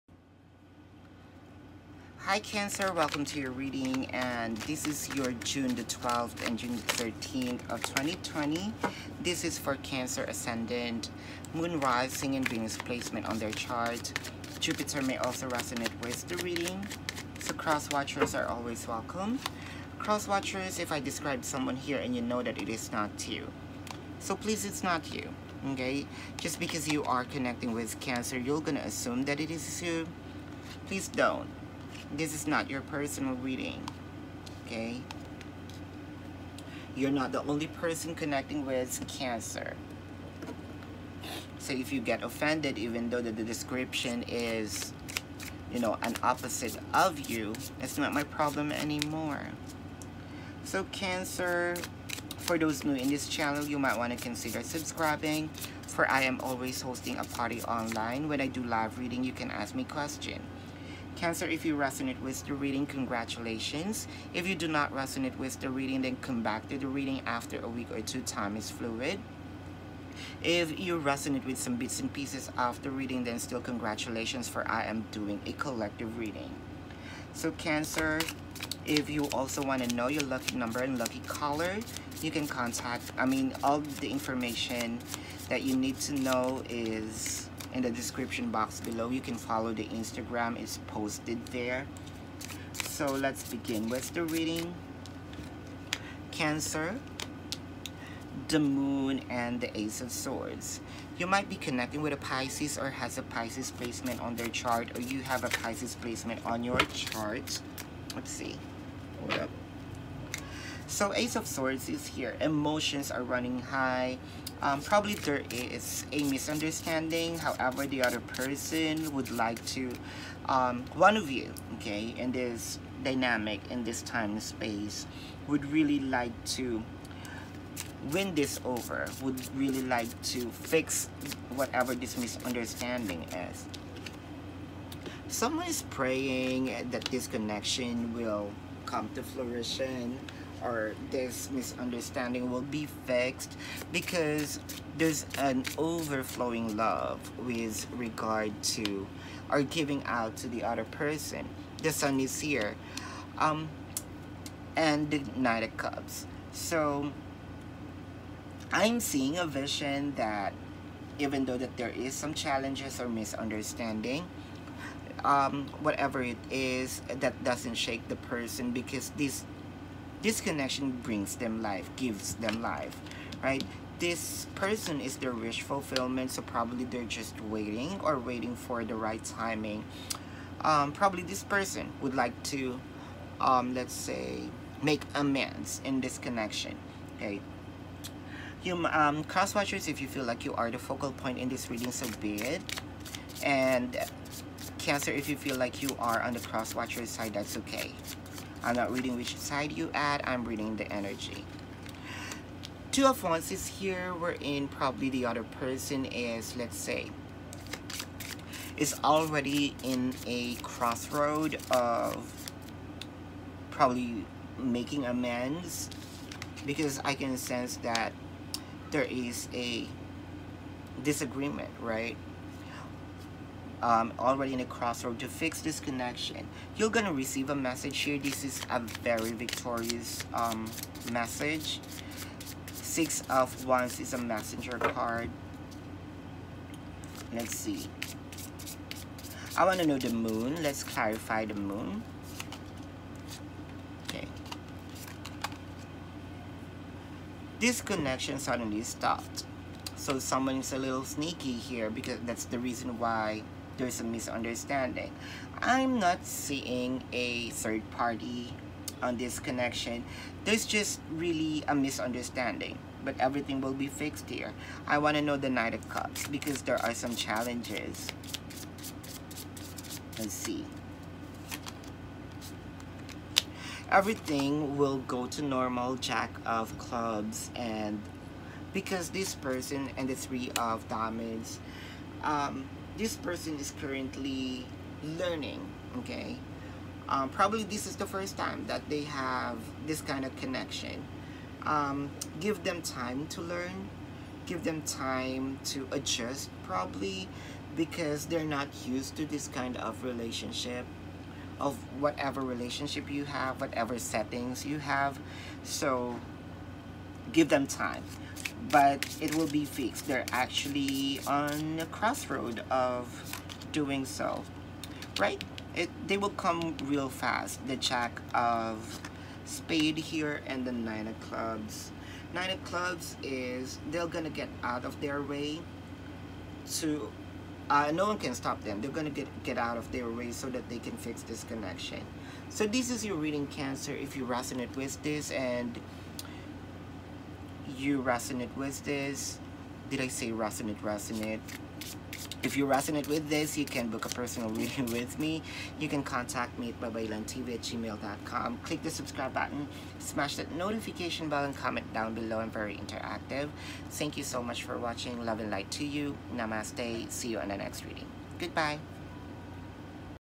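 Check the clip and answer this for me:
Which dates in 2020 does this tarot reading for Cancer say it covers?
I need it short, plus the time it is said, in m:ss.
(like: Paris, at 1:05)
June 12 and June 13, at 0:05.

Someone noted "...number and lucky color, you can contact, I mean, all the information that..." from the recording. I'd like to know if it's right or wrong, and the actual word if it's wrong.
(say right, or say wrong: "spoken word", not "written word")
right.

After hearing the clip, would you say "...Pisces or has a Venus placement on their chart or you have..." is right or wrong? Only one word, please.
wrong.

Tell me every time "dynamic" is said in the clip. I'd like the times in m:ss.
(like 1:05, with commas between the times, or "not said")
2:03.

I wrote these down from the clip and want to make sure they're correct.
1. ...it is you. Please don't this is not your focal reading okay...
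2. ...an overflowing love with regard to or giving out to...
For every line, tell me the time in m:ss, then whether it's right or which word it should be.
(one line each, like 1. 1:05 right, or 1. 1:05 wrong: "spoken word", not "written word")
1. 0:29 wrong: "personal", not "focal"
2. 2:25 right.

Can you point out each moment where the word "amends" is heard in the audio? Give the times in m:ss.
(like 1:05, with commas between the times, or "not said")
3:05, 3:35.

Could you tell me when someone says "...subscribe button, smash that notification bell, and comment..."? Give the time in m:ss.
5:48.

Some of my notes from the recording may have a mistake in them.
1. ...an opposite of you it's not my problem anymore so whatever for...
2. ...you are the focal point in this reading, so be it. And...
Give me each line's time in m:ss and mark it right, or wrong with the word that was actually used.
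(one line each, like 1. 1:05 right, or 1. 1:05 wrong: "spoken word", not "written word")
1. 0:46 wrong: "cancer", not "whatever"
2. 3:10 right.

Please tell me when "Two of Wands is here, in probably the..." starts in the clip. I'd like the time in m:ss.
3:22.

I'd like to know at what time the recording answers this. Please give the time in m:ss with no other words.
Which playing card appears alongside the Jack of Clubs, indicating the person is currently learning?
4:40.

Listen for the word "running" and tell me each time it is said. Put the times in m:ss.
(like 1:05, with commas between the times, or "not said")
1:53.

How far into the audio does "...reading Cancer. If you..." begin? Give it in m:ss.
5:33.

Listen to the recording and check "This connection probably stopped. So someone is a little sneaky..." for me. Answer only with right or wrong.
wrong.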